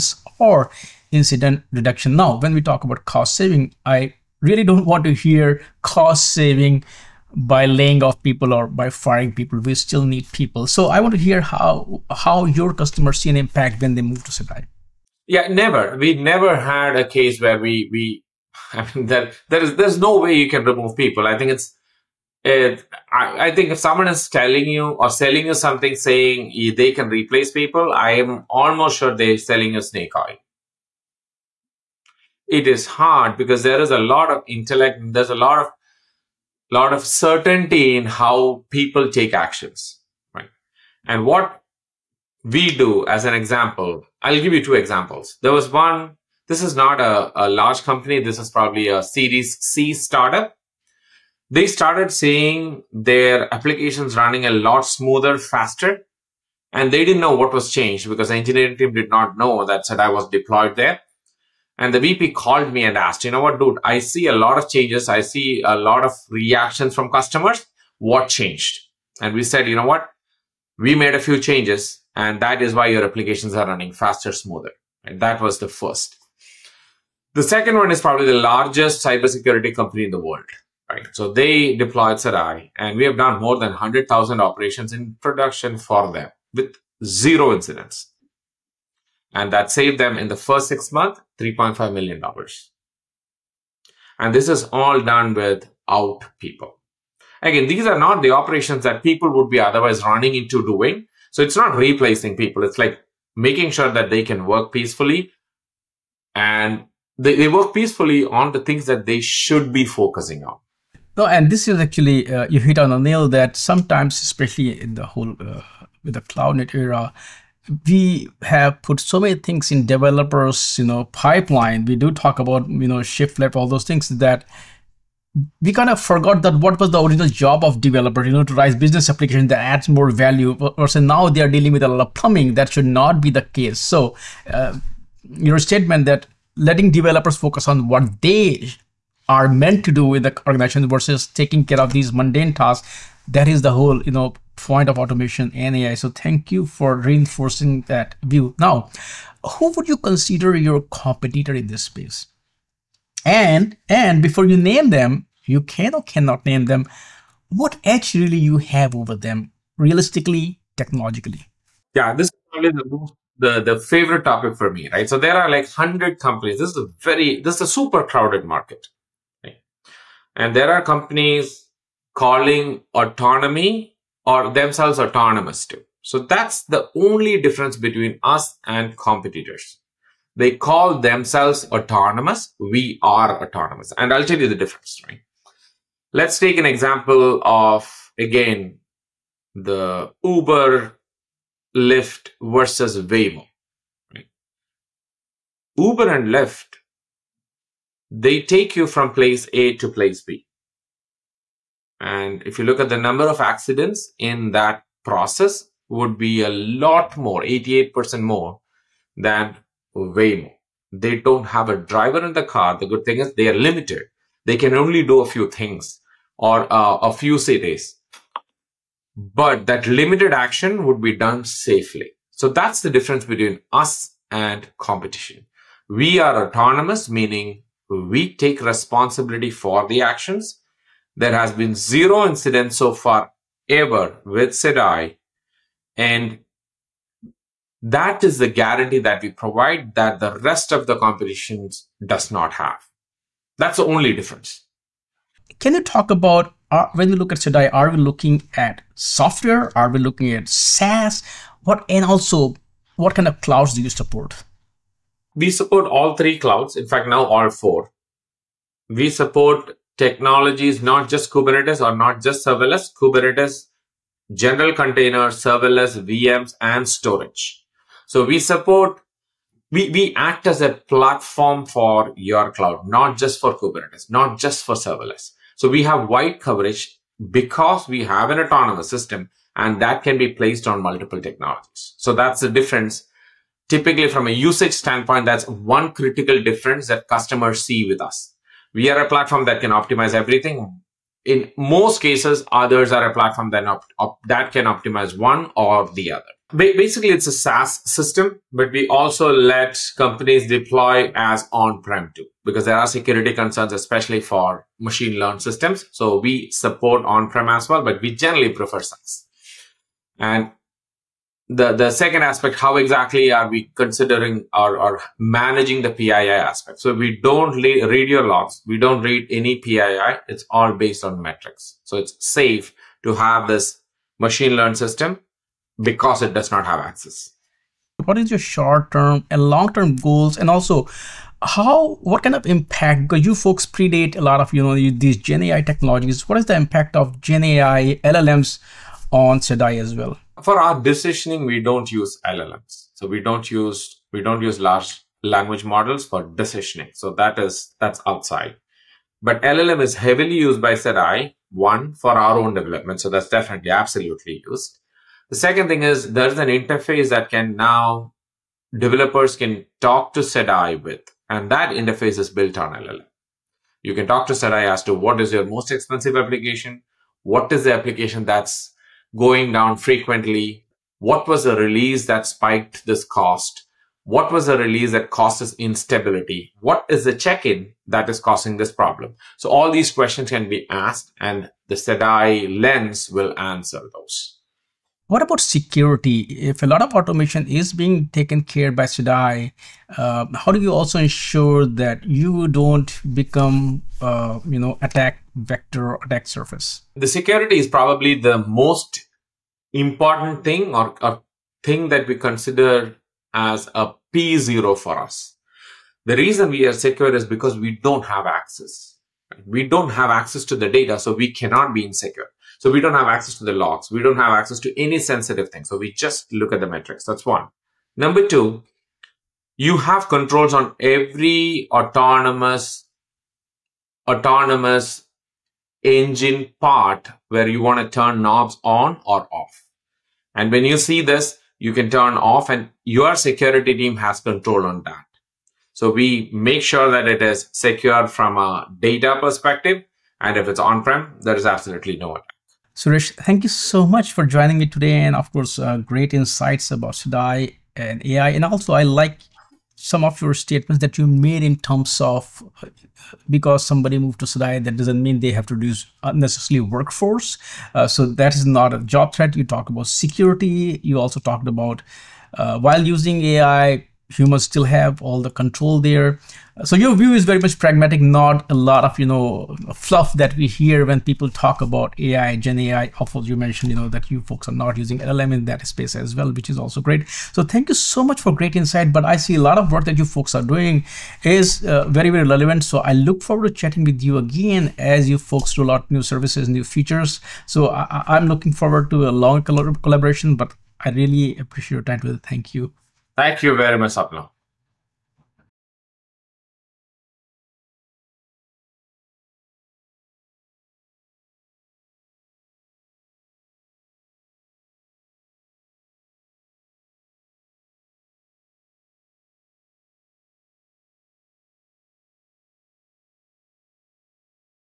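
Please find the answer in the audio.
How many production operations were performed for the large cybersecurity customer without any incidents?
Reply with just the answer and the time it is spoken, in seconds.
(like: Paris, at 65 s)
100,000, at 83 s.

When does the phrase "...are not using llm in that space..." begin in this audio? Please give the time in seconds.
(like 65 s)
474 s.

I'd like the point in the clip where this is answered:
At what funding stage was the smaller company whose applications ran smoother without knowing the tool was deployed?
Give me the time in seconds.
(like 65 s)
49 s.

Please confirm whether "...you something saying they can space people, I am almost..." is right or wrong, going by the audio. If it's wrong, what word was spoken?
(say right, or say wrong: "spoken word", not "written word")
wrong: "replace", not "space".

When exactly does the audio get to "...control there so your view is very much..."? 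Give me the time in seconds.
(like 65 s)
465 s.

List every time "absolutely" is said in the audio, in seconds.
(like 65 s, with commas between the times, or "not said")
353 s, 441 s.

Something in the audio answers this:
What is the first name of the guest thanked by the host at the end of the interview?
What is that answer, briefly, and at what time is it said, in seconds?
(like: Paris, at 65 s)
Suresh, at 442 s.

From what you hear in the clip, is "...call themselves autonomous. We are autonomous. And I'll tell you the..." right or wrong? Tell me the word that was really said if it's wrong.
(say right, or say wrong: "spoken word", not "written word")
right.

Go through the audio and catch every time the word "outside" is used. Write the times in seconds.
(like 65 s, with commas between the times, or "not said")
348 s.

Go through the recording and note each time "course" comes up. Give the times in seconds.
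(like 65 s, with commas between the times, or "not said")
445 s, 473 s.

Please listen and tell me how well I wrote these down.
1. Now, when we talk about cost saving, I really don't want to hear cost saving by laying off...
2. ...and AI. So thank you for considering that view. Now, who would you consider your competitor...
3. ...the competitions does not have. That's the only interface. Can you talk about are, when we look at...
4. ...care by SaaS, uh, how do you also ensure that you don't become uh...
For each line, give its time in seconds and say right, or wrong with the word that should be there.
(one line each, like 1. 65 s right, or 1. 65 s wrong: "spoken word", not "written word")
1. 2 s right
2. 145 s wrong: "reinforcing", not "considering"
3. 240 s wrong: "difference", not "interface"
4. 388 s wrong: "SEDAI", not "SaaS".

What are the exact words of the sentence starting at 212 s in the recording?
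The good thing is they are limited.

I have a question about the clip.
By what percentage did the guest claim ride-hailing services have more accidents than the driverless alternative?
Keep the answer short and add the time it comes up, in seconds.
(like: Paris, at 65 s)
88%, at 207 s.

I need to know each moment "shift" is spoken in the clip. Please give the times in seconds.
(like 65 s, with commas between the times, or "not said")
123 s.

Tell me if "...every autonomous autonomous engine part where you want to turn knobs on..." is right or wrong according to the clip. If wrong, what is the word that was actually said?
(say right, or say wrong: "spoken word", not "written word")
right.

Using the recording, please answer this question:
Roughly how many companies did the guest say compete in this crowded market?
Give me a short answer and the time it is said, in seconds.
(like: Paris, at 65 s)
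100, at 165 s.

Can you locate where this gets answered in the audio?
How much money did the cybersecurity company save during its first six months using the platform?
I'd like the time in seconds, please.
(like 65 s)
91 s.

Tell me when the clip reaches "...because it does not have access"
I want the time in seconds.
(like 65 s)
325 s.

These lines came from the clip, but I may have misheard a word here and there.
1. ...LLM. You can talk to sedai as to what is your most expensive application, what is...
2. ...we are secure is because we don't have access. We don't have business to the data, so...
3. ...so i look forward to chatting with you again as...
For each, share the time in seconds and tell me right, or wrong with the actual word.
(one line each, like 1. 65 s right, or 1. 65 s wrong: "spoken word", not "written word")
1. 362 s right
2. 406 s wrong: "access", not "business"
3. 482 s right.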